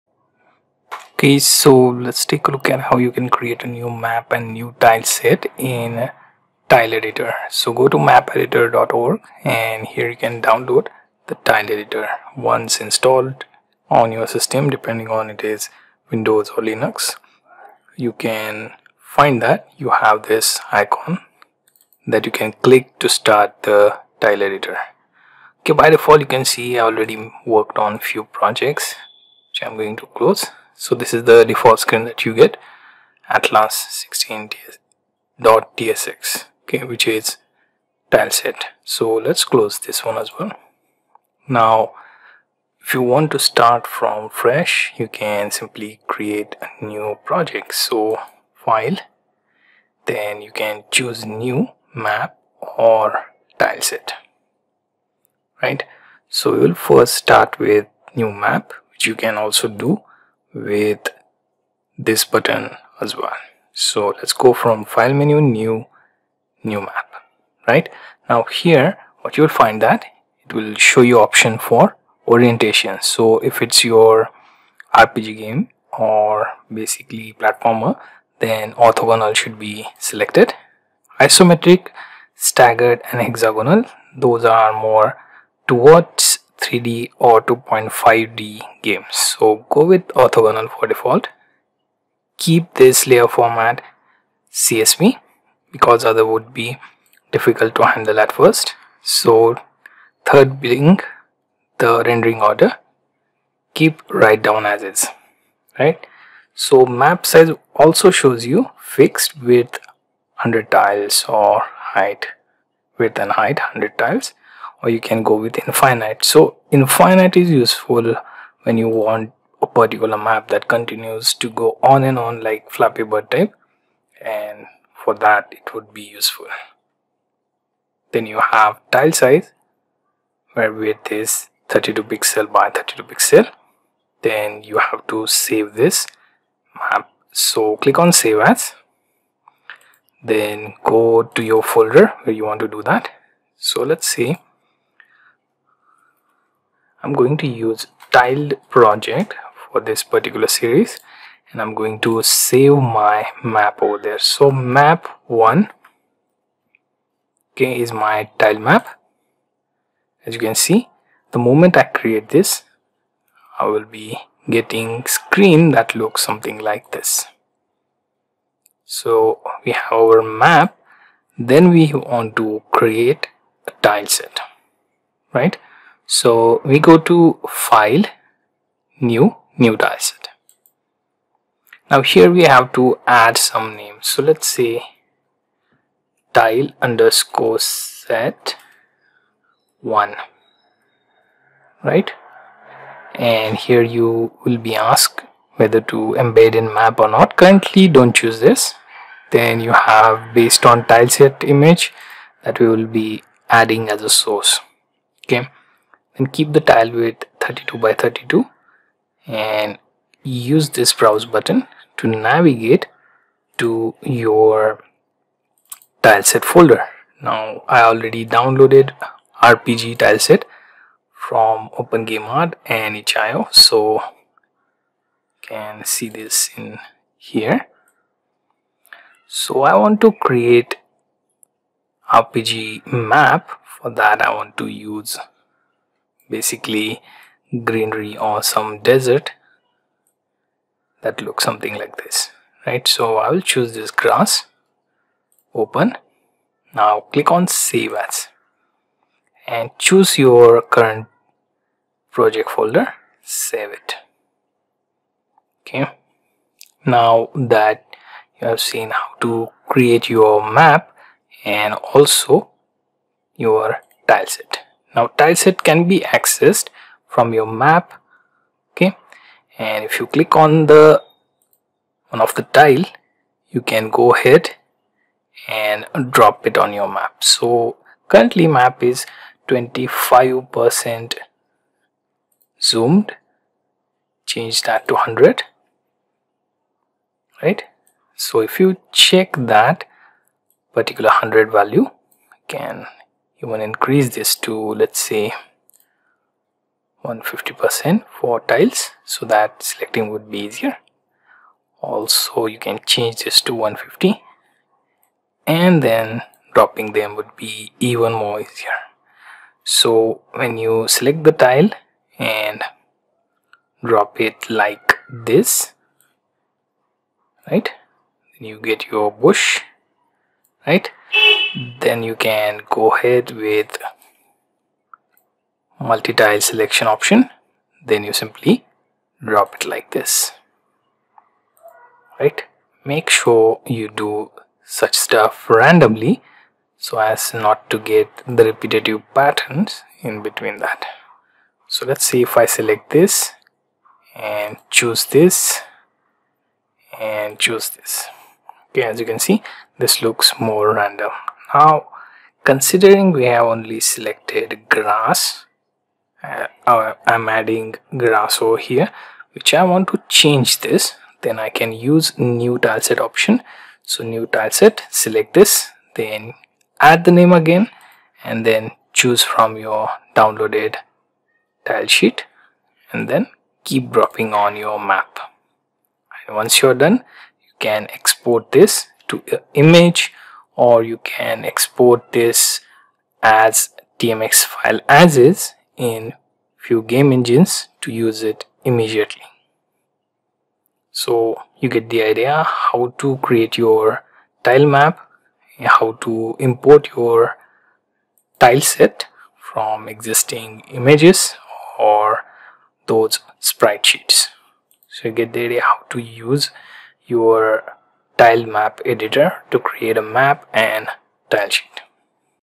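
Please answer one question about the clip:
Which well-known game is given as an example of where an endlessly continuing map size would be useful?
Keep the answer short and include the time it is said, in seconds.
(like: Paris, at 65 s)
Flappy Bird, at 122 s.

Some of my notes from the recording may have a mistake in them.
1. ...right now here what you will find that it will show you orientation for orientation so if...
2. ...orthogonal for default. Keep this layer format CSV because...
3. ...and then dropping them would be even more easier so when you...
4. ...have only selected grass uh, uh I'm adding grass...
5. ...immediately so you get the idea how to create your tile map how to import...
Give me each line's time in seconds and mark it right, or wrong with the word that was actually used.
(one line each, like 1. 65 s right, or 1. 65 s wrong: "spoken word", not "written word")
1. 67 s wrong: "option", not "orientation"
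2. 90 s right
3. 305 s right
4. 353 s right
5. 388 s right.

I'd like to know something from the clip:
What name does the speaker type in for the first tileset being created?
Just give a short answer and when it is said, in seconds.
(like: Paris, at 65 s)
tile_set1, at 186 s.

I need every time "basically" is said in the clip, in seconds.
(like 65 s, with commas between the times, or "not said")
76 s, 236 s.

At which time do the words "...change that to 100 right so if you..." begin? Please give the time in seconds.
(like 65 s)
284 s.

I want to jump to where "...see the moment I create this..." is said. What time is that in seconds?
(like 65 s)
160 s.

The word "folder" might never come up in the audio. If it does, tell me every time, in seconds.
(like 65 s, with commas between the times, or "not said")
141 s, 216 s, 252 s.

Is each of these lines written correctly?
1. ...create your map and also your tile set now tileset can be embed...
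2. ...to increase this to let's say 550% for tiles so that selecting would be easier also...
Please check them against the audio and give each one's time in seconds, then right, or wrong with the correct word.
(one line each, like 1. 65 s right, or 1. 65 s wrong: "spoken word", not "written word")
1. 259 s wrong: "accessed", not "embed"
2. 293 s wrong: "150", not "550".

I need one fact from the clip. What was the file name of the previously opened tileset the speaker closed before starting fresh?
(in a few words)
atlas 16.tsx.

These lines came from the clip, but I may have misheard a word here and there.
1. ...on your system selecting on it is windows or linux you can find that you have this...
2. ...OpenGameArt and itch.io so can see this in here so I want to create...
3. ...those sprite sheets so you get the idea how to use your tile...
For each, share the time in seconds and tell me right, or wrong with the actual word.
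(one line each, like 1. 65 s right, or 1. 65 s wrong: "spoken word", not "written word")
1. 13 s wrong: "depending", not "selecting"
2. 221 s right
3. 402 s right.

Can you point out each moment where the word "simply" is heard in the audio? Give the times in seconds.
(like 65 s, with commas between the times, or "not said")
45 s, 328 s.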